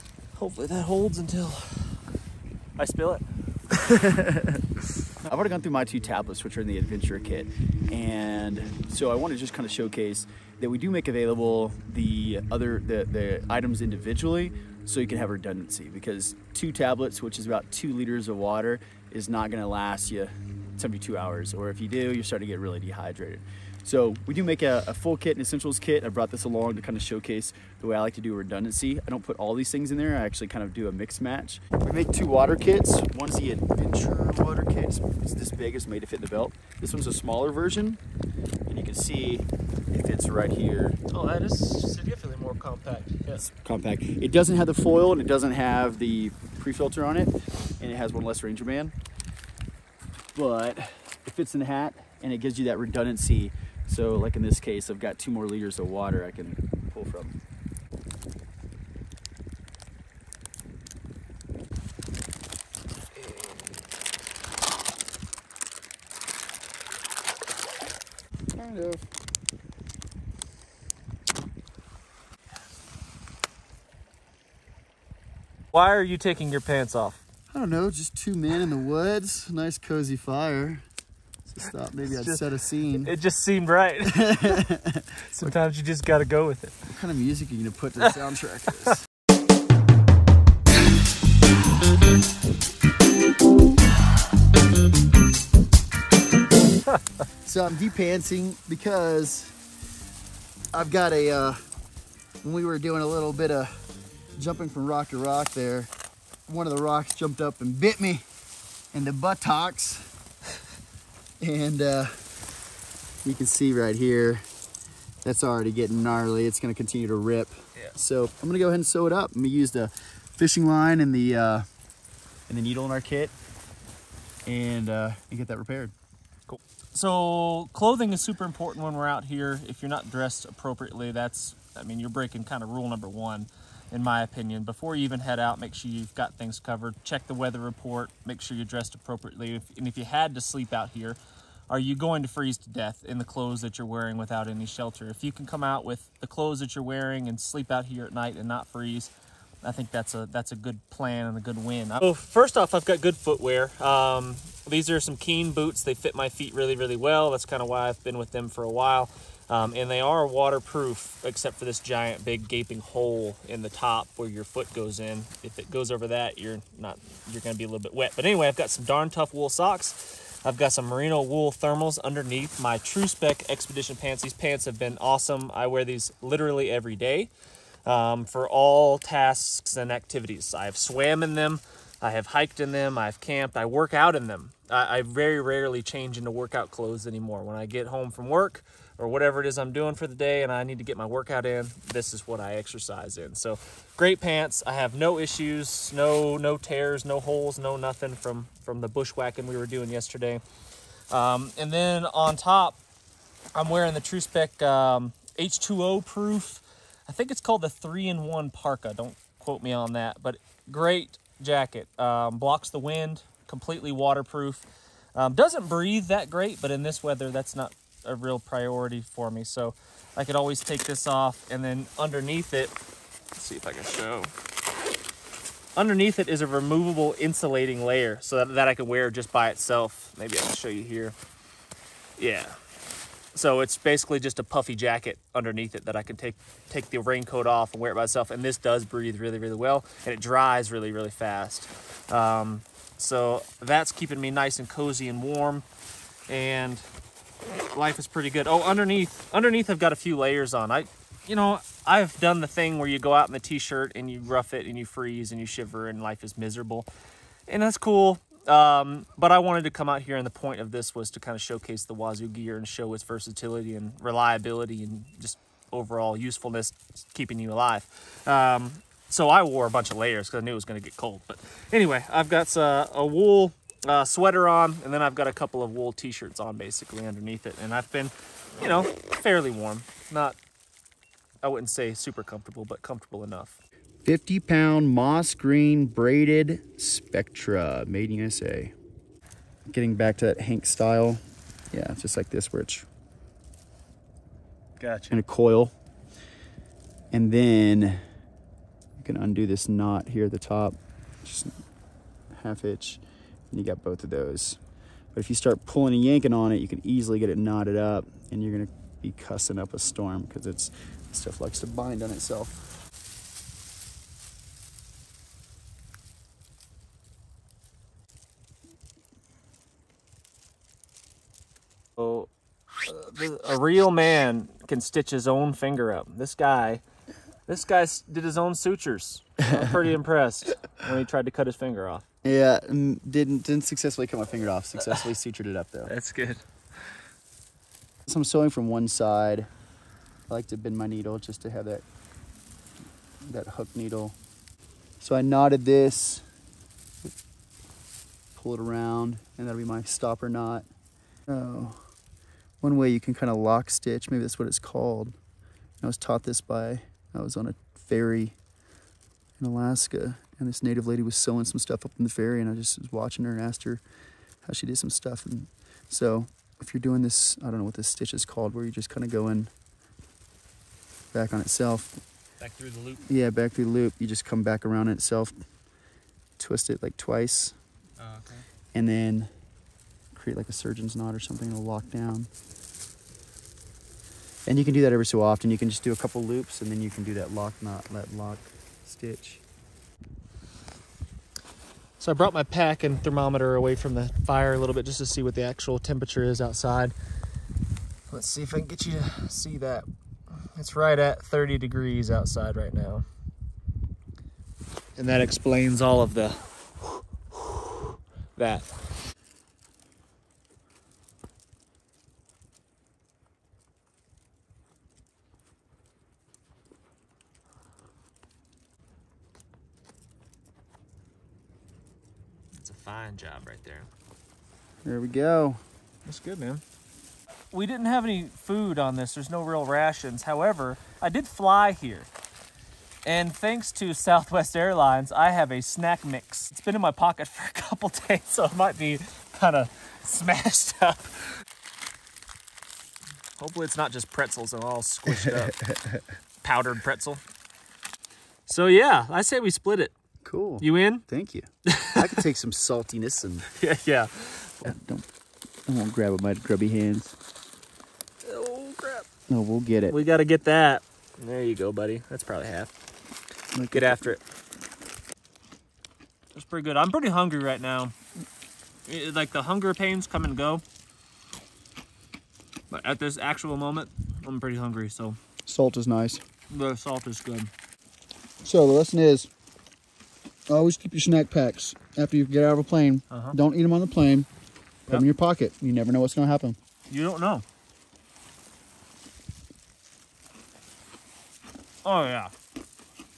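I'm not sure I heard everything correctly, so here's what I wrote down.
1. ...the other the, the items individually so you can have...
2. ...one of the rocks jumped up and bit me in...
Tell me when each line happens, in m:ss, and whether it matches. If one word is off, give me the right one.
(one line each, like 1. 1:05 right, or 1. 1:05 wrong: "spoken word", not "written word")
1. 0:11 right
2. 1:46 right.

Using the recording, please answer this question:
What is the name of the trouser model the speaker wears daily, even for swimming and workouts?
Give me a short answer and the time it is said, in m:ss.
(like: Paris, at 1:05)
TruSpec Expedition, at 2:52.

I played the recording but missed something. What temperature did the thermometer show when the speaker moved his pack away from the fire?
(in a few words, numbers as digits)
30 degrees.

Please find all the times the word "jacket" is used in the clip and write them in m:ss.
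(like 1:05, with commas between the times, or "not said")
3:31, 3:54.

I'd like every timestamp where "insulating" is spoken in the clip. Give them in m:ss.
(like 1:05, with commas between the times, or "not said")
3:47.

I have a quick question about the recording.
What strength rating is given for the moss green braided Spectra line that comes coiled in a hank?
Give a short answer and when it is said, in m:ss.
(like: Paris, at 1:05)
50 pound, at 4:44.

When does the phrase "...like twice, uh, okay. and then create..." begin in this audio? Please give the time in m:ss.
6:16.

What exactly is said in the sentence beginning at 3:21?
Um, and then on top, I'm wearing the TruSpec um, H2O proof.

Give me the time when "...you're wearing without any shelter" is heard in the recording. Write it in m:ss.
2:23.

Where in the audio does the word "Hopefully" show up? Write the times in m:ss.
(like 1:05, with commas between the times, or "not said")
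0:00, 7:23.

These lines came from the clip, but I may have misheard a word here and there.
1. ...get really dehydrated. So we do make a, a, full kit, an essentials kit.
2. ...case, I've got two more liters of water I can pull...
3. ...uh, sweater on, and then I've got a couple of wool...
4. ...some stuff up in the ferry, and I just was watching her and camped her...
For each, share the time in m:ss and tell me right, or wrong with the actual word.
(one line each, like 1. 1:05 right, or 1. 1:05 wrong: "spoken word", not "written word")
1. 0:22 right
2. 0:54 right
3. 4:33 right
4. 6:01 wrong: "asked", not "camped".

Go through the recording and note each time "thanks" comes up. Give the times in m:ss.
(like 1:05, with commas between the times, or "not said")
7:13, 7:30.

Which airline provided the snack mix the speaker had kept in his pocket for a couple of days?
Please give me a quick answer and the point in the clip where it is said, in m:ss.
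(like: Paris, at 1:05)
Southwest Airlines, at 7:13.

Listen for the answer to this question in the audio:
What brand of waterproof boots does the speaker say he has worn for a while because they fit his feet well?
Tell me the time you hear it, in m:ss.
2:35.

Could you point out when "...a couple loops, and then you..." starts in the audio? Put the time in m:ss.
6:25.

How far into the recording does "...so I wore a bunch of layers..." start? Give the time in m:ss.
4:29.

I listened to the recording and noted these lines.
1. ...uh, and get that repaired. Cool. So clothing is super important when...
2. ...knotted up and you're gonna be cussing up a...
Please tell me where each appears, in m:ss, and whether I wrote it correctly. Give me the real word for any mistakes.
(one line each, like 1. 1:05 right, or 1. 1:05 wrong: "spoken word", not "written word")
1. 2:04 right
2. 5:07 right.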